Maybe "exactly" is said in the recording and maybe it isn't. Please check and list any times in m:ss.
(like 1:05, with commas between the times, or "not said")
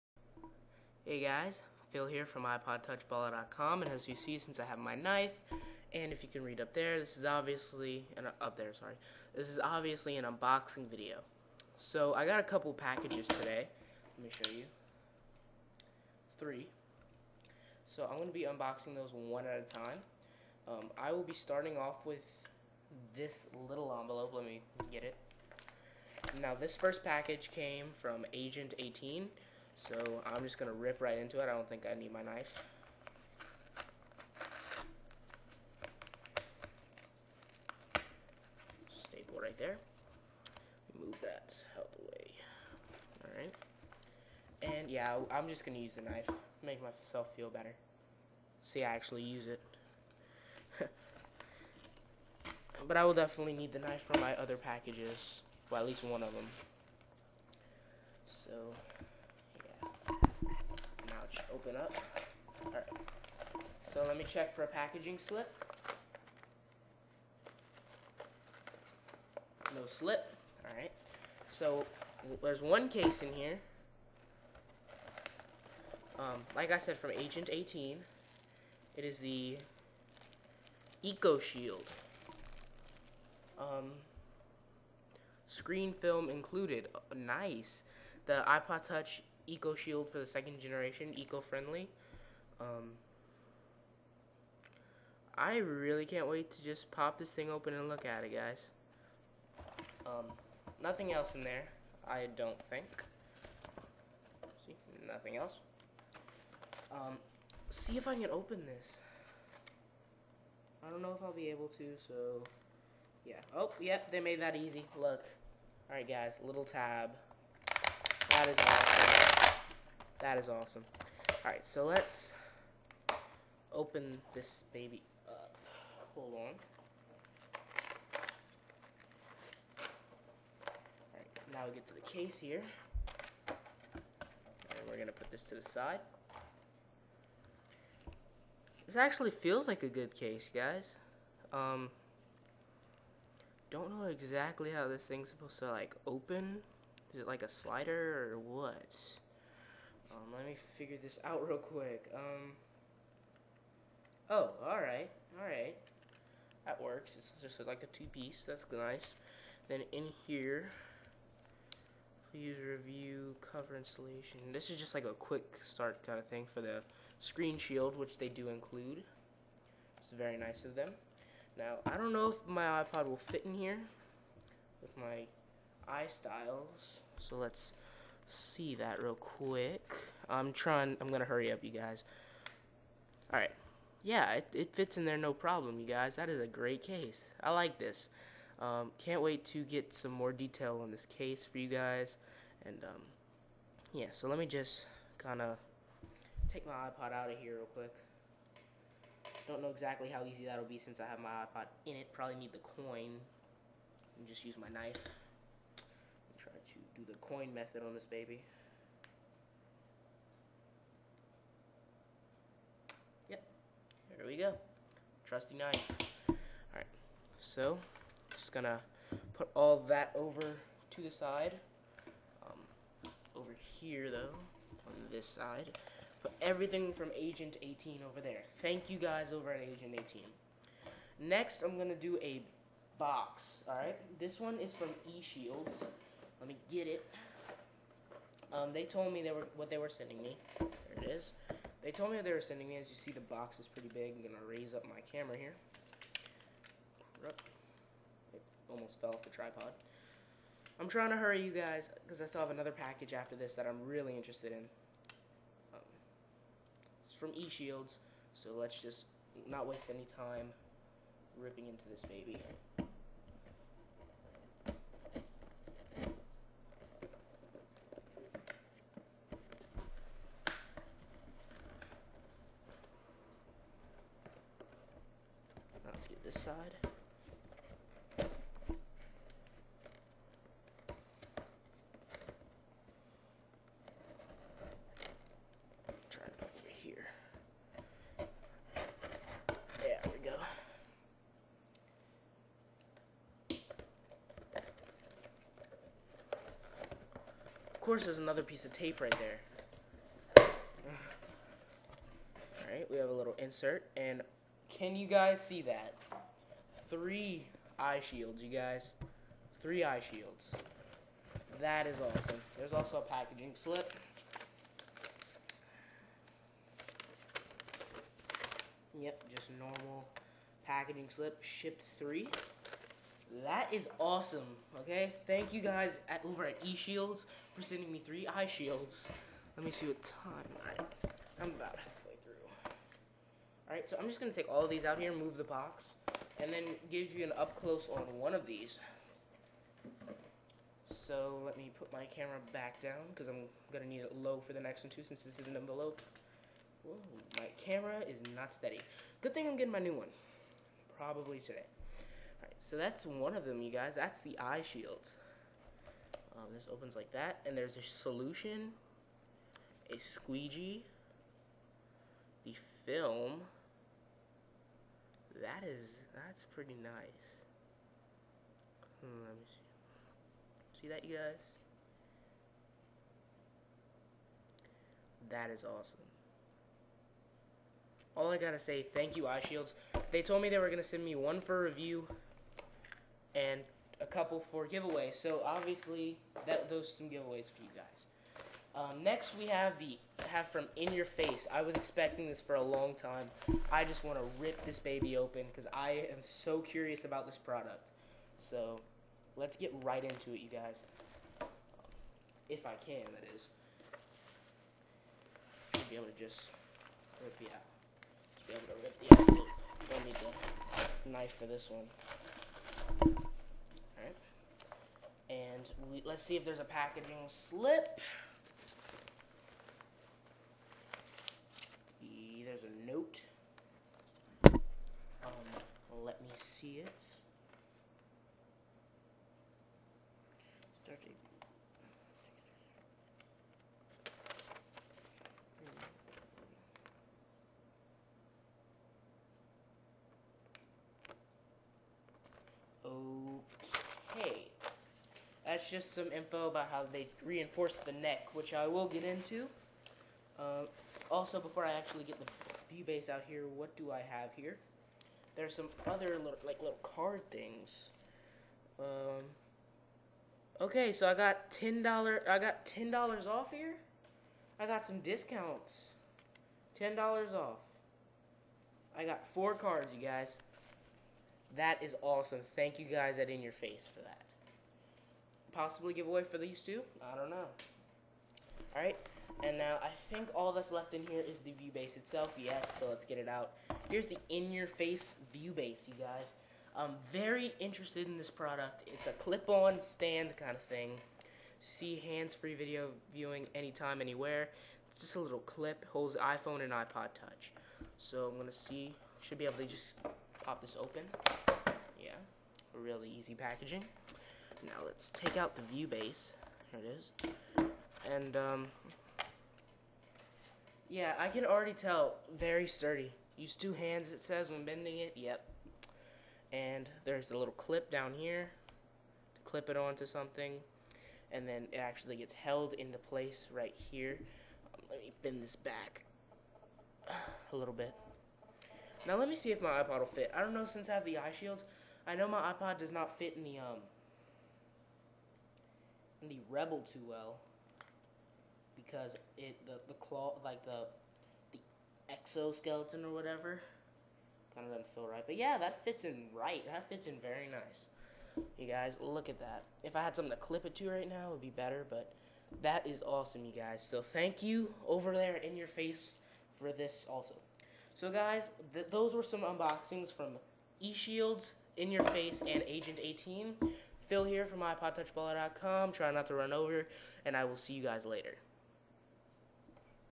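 2:24, 3:19.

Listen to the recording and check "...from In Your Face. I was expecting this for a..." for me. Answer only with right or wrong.
right.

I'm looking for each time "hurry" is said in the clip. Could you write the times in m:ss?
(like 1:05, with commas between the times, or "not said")
3:01, 4:11.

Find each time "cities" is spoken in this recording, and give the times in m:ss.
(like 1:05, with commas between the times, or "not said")
not said.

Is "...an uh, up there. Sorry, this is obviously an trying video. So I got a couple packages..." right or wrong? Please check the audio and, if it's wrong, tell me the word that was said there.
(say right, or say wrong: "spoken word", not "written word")
wrong: "unboxing", not "trying".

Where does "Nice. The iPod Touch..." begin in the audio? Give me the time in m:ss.
1:27.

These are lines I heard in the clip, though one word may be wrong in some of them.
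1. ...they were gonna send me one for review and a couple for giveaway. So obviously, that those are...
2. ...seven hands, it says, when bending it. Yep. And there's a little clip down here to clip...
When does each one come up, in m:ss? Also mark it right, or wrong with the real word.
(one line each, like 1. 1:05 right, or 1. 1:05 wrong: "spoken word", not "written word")
1. 6:20 right
2. 8:33 wrong: "two", not "seven".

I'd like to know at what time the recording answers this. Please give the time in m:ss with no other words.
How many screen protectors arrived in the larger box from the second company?
5:06.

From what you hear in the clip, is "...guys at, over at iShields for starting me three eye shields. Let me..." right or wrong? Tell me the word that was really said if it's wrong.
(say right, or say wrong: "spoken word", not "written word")
wrong: "sending", not "starting".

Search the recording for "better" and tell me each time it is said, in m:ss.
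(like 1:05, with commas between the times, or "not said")
0:47, 9:11.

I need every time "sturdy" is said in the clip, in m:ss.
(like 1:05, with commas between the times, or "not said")
8:32.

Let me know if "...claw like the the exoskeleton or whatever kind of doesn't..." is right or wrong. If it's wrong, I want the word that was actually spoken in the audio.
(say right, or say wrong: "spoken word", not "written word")
right.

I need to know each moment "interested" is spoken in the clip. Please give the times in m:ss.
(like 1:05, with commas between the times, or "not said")
4:14, 8:07.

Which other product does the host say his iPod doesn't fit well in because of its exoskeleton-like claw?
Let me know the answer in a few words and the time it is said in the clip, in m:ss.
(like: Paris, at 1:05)
Rebel, at 8:56.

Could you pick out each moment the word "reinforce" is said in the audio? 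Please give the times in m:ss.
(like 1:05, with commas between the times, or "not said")
7:27.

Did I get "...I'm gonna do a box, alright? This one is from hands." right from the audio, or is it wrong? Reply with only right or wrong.
wrong.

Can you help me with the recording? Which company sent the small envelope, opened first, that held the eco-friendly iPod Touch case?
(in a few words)
Agent 18.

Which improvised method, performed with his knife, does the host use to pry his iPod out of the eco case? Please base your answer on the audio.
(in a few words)
coin method.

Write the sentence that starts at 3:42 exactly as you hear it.
Um, over here though, on this side.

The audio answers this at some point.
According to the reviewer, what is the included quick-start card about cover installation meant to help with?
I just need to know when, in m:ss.
2:45.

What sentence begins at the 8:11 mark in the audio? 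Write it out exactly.
See hands-free video viewing anytime, anywhere.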